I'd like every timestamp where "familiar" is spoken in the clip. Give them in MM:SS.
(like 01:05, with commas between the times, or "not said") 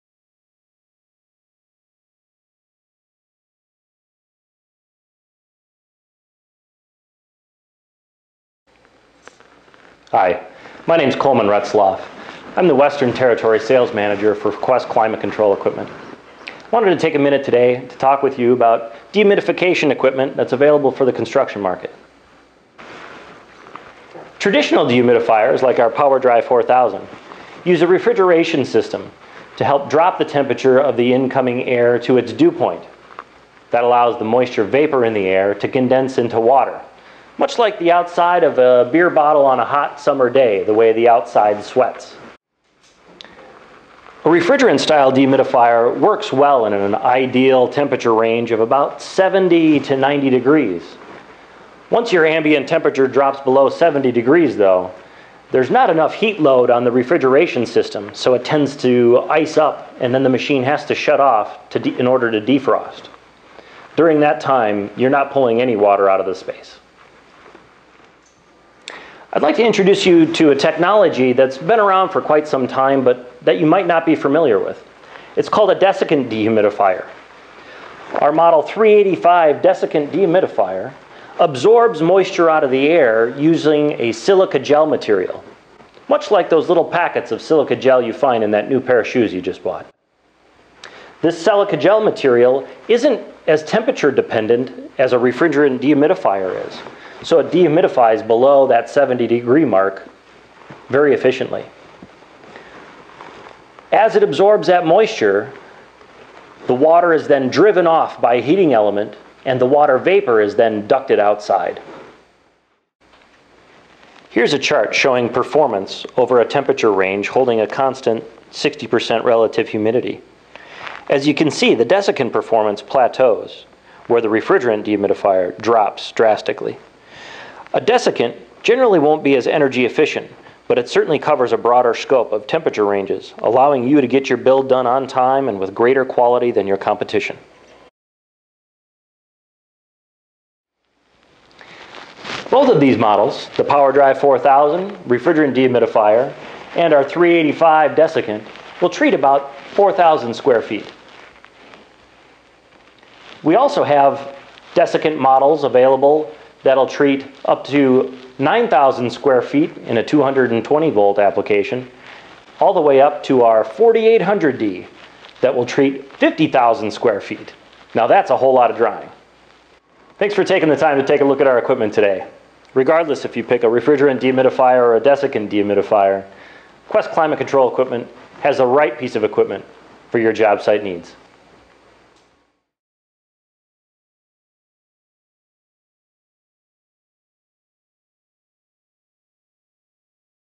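01:14.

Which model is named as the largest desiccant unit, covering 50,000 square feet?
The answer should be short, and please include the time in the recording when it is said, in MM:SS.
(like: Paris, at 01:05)
4800D, at 02:43.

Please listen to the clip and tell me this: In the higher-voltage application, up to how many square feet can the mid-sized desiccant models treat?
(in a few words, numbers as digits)
9,000 square feet.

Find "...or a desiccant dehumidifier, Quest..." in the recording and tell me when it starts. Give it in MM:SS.
02:54.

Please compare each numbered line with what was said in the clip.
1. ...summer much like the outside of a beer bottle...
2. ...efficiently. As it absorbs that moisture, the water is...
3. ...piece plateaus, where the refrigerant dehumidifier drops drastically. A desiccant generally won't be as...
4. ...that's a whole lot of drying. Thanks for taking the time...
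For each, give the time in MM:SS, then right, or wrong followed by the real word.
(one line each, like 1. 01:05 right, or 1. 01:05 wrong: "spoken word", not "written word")
1. 00:36 wrong: "water", not "summer"
2. 01:41 right
3. 02:02 wrong: "performance", not "piece"
4. 02:48 right.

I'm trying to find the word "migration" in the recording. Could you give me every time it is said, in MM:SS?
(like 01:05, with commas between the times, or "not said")
not said.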